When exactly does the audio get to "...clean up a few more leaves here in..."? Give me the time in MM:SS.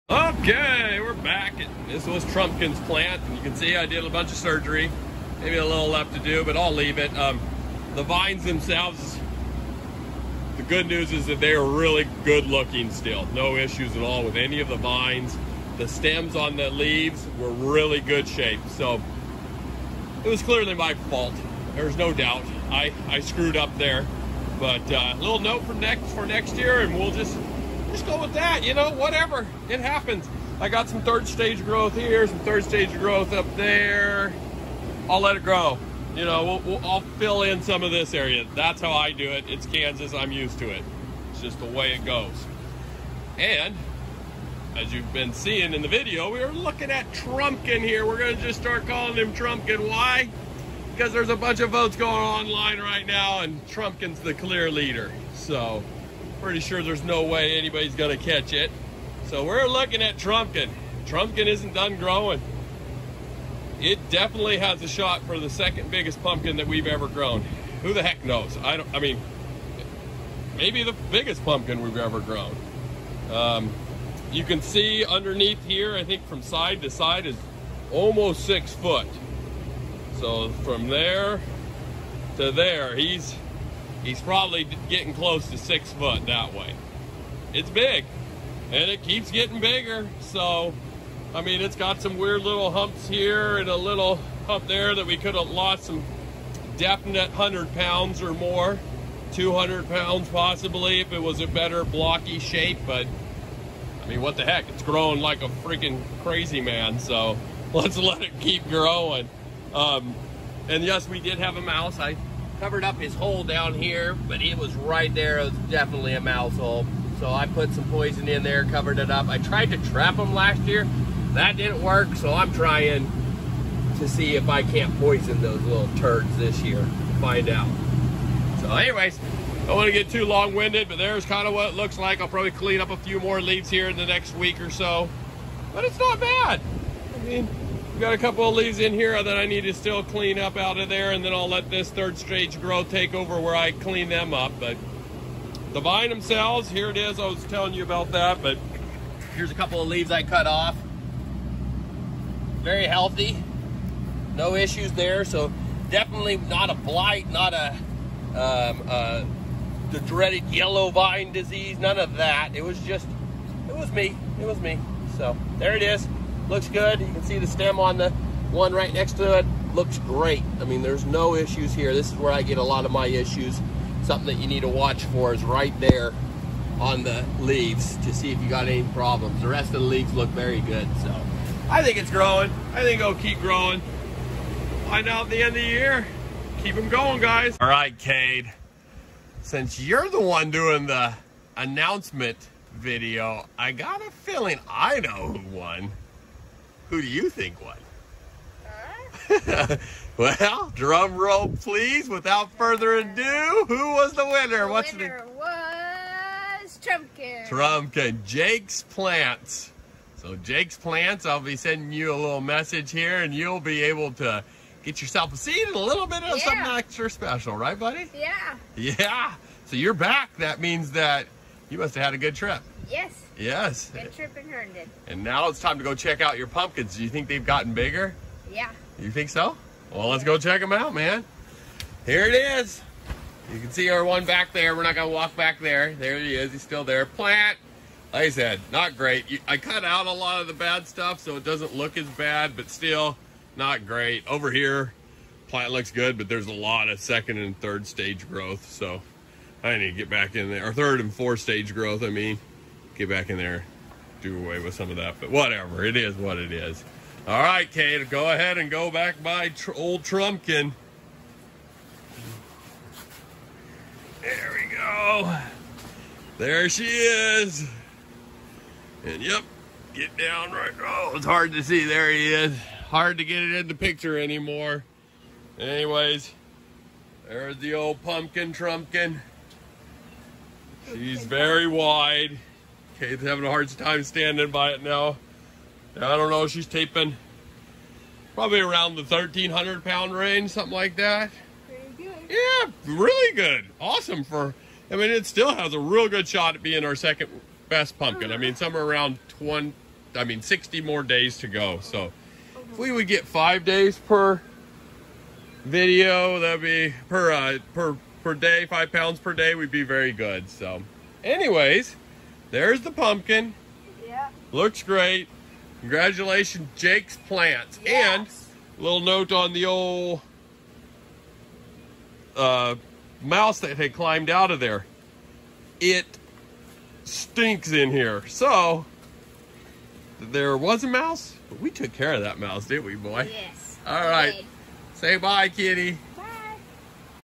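02:12.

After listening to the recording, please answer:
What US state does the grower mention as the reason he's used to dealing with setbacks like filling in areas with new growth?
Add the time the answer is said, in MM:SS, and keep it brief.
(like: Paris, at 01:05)
Kansas, at 00:39.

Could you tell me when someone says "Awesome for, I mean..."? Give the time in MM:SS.
04:53.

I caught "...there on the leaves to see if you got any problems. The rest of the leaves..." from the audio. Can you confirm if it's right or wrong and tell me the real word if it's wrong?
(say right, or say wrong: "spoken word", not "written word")
right.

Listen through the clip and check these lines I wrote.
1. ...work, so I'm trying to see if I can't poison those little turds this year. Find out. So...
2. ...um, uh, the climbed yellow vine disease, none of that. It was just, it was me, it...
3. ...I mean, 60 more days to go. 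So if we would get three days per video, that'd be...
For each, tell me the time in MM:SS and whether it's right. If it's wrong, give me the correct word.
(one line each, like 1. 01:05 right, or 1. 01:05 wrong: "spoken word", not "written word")
1. 02:01 right
2. 02:38 wrong: "dreaded", not "climbed"
3. 05:00 wrong: "five", not "three".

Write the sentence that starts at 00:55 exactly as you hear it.
So pretty sure there's no way anybody's going to catch it.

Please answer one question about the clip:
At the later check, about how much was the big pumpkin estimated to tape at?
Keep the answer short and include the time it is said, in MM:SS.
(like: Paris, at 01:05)
1,300 pounds, at 04:49.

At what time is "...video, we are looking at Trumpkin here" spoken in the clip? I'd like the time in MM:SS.
00:45.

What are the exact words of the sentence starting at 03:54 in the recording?
We're not going to walk back there.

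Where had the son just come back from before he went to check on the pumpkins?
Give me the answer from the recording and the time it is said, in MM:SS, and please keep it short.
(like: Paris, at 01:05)
Herndon, at 03:44.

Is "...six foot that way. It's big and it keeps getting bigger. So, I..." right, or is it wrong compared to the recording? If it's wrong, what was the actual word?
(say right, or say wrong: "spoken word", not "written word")
right.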